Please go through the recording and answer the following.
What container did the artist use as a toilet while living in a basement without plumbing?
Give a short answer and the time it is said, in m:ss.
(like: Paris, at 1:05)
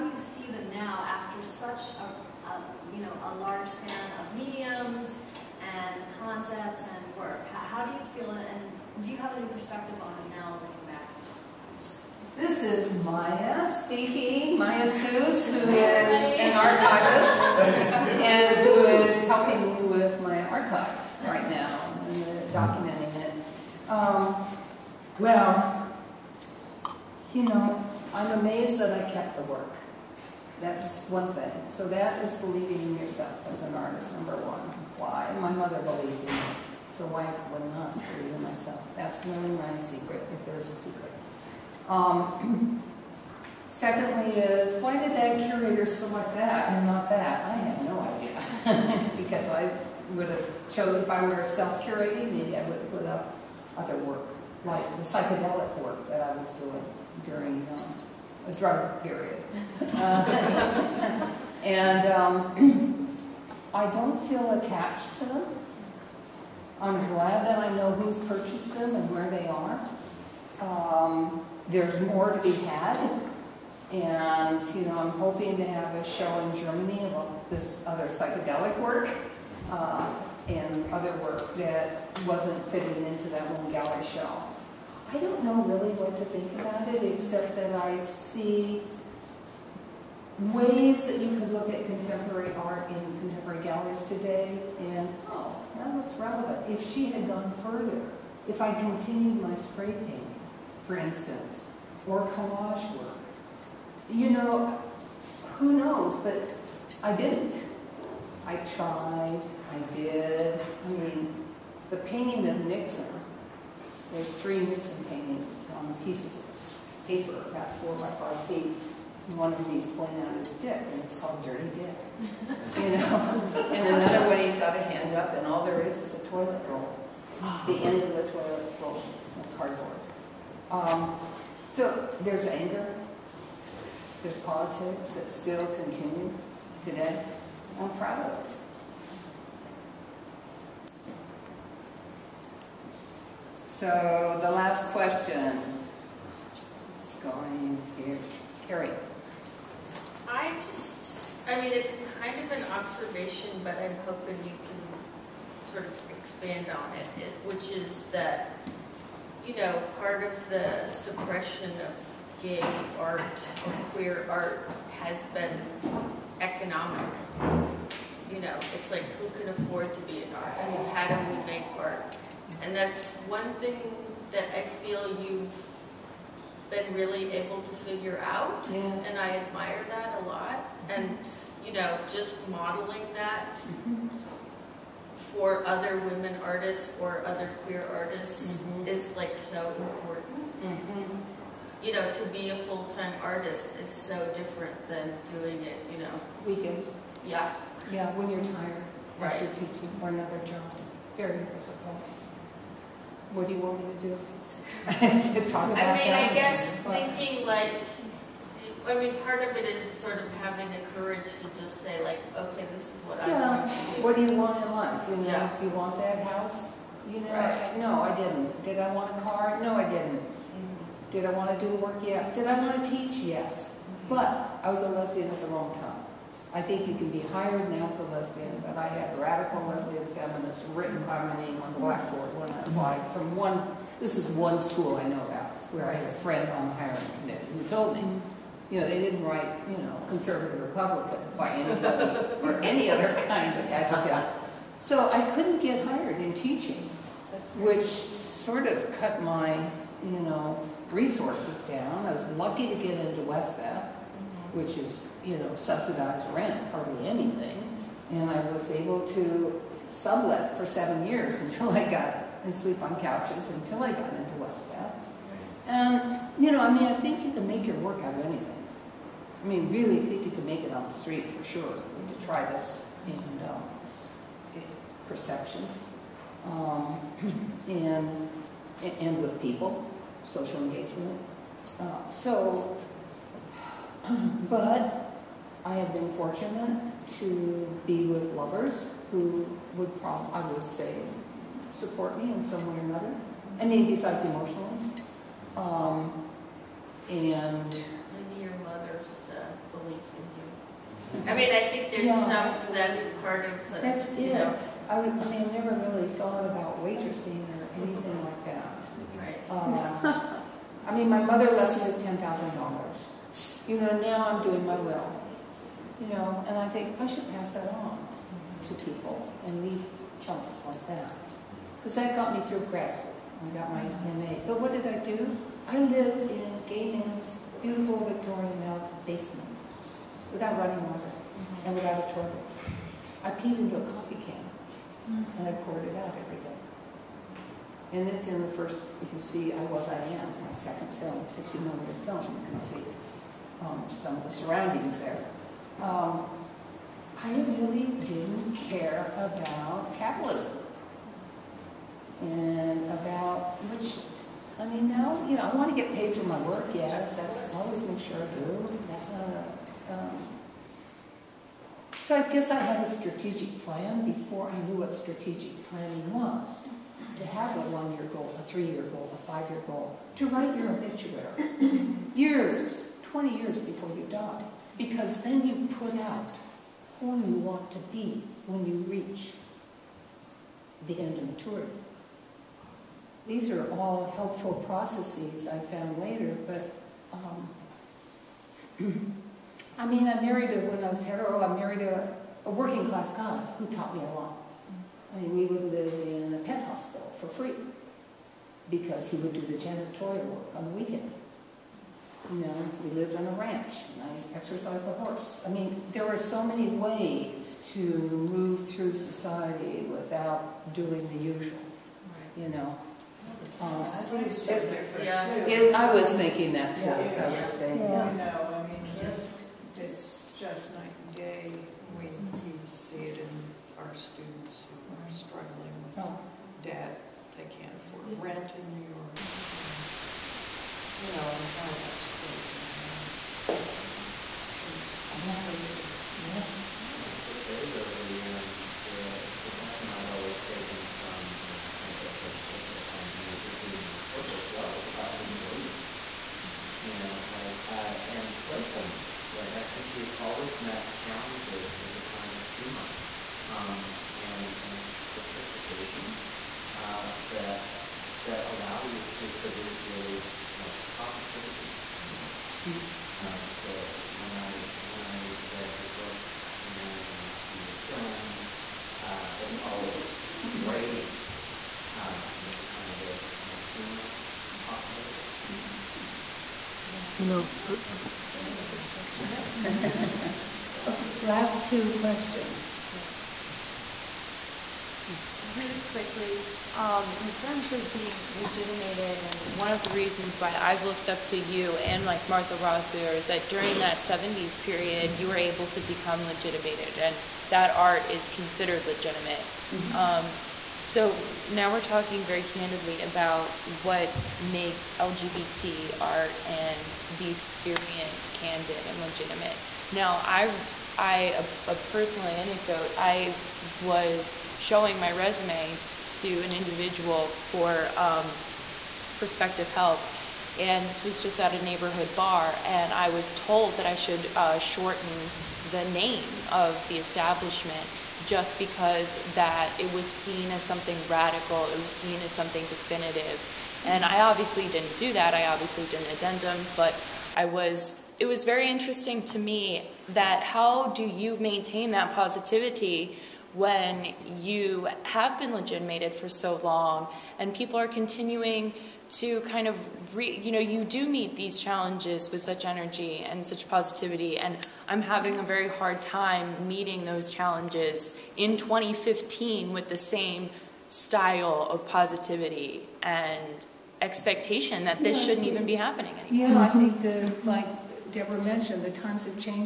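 A coffee can, at 5:33.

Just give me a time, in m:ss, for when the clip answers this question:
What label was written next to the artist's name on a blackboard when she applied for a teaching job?
3:49.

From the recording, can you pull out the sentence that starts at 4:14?
which is, you know, subsidized rent, hardly anything.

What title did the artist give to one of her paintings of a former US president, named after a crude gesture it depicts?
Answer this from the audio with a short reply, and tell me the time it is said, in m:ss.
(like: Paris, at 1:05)
Dirty Dick, at 2:01.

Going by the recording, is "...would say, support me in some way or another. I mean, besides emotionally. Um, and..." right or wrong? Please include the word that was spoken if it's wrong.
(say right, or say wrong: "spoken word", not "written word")
right.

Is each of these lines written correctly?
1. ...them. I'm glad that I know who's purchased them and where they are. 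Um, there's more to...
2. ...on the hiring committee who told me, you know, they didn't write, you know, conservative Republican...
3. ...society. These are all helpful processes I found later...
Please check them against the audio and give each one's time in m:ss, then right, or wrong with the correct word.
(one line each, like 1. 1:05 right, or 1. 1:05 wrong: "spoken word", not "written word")
1. 1:05 right
2. 3:56 right
3. 6:21 wrong: "maturity", not "society".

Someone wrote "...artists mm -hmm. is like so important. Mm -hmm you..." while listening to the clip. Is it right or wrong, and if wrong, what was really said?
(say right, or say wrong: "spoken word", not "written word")
right.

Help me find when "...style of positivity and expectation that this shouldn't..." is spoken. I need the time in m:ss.
9:20.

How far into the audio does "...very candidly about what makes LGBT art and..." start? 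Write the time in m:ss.
8:22.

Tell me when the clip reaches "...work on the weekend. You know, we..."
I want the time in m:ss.
6:40.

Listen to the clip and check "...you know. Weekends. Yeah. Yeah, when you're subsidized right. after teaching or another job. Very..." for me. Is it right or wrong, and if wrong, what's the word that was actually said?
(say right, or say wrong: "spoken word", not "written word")
wrong: "tired", not "subsidized".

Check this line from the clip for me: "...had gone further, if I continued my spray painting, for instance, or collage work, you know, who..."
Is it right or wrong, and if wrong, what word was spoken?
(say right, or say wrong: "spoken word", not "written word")
right.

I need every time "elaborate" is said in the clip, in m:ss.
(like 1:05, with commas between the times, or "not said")
not said.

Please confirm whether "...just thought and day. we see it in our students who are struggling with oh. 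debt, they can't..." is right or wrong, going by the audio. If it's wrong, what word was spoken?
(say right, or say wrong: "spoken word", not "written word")
wrong: "night", not "thought".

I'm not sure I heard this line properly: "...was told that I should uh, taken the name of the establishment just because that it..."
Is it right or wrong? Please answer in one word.
wrong.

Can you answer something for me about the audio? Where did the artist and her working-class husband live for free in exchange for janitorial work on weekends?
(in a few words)
A pet hospital.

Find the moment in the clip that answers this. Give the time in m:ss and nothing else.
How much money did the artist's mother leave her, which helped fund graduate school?
5:12.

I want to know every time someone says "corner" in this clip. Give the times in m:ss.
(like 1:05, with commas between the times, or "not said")
not said.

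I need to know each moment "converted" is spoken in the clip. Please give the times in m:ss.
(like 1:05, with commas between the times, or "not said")
not said.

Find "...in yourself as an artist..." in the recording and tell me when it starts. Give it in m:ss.
0:32.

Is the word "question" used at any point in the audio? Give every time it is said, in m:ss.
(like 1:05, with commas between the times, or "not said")
2:24, 8:01.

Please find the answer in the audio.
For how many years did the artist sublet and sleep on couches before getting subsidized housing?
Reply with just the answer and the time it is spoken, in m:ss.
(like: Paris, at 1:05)
7, at 4:20.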